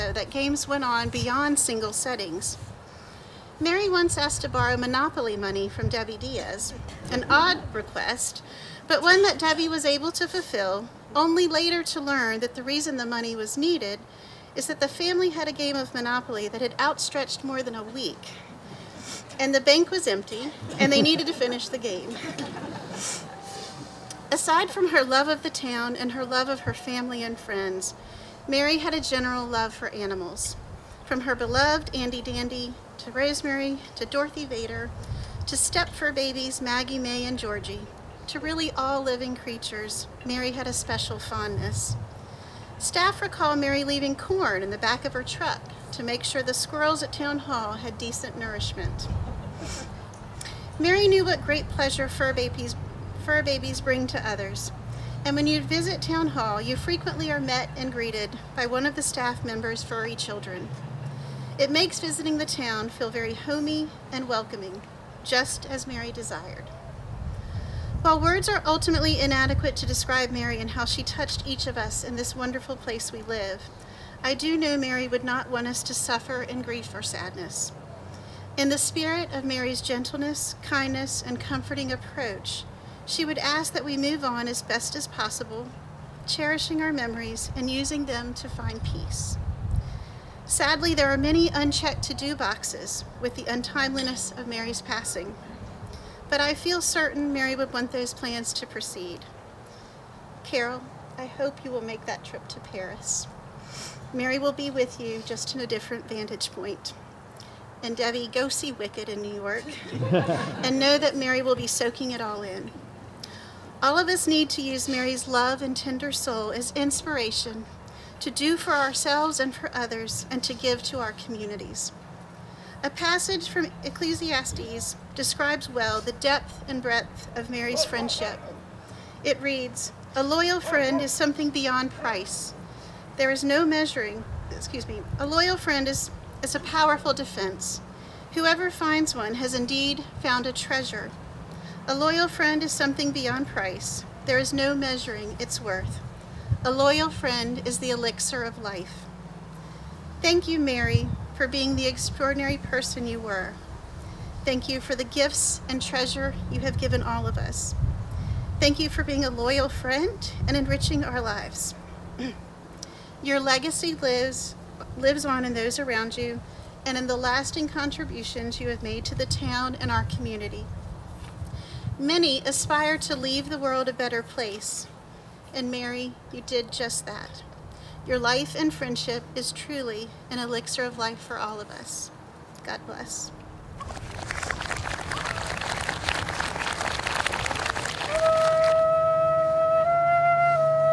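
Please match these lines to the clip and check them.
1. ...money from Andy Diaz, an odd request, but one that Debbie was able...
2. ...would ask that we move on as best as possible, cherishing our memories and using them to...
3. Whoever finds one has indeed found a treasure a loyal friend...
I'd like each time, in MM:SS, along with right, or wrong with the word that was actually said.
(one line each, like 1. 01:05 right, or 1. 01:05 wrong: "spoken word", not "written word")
1. 00:05 wrong: "Debbie", not "Andy"
2. 01:23 right
3. 02:18 right.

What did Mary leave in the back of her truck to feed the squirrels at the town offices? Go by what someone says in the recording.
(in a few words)
Corn.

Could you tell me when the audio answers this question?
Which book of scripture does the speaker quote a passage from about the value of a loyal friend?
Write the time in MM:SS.
02:03.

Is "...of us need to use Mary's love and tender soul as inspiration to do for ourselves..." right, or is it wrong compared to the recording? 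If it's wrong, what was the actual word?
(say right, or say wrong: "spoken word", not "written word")
right.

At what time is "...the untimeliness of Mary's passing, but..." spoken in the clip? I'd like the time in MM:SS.
01:33.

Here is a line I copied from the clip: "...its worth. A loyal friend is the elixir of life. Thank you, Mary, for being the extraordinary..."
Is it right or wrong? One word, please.
right.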